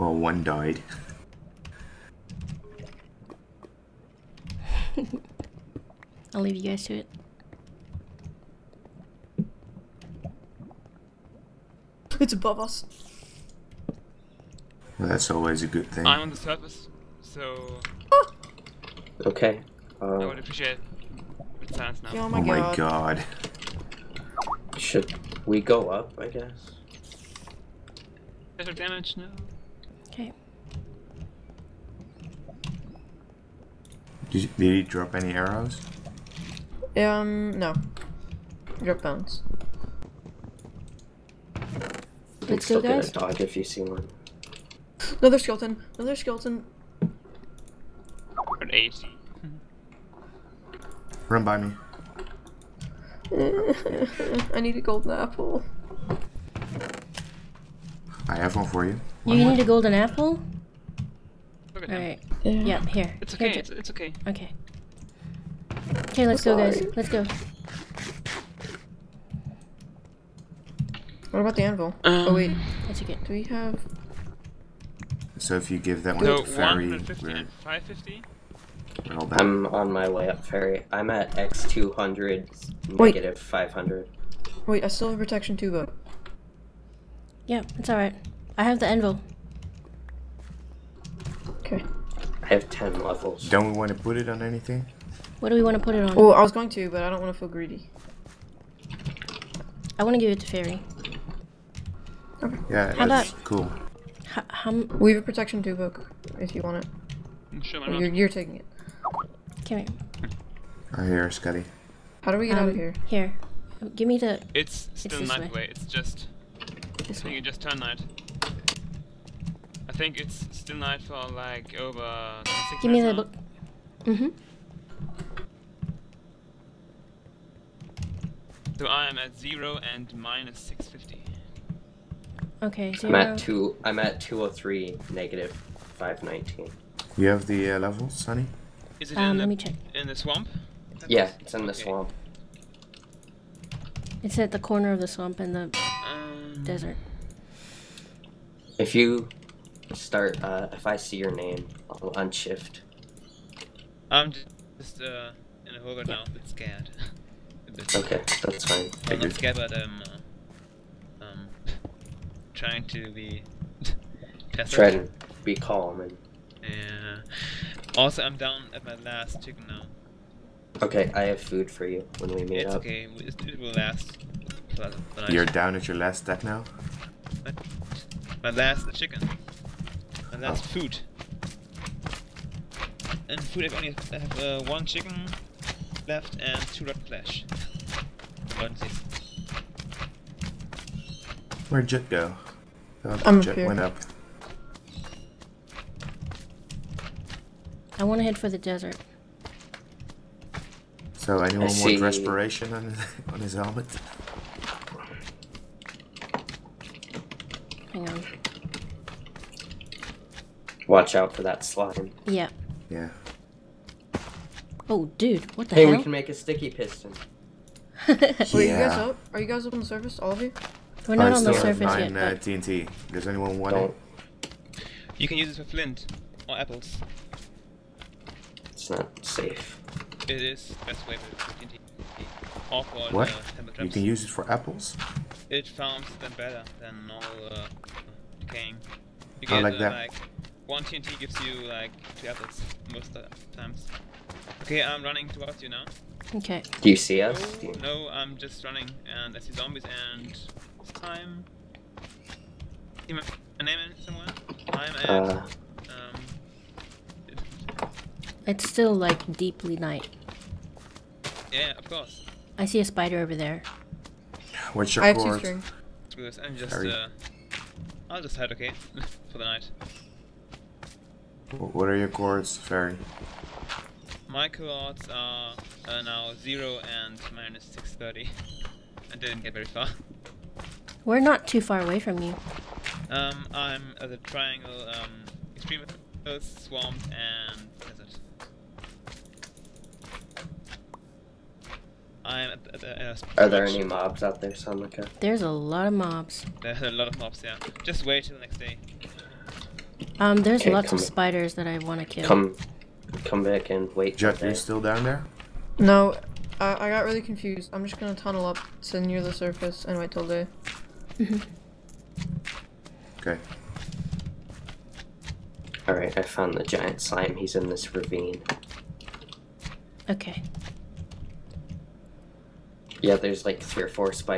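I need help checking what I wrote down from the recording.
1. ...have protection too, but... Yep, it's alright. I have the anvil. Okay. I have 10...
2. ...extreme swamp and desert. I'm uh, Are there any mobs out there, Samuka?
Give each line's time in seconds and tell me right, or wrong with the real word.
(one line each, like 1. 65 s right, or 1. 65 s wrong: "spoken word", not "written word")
1. 85 s right
2. 285 s right.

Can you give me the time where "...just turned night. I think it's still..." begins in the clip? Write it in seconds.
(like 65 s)
117 s.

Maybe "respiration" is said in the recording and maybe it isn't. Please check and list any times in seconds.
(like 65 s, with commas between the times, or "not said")
202 s.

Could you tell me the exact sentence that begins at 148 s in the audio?
If you start, uh, if I see your name, I'll unshift.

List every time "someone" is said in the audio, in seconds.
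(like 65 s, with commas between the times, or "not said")
254 s.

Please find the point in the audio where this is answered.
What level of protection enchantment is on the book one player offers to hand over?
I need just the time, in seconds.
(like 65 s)
105 s.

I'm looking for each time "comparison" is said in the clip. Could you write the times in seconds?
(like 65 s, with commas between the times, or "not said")
not said.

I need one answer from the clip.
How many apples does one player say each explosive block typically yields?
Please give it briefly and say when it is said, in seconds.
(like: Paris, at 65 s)
2, at 242 s.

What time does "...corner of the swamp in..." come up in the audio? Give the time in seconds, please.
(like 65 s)
144 s.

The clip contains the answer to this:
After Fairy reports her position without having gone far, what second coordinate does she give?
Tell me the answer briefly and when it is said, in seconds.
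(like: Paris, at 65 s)
-630, at 277 s.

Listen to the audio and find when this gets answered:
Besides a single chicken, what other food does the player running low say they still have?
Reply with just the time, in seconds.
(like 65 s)
186 s.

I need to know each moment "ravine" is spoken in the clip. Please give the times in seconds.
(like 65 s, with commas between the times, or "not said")
317 s.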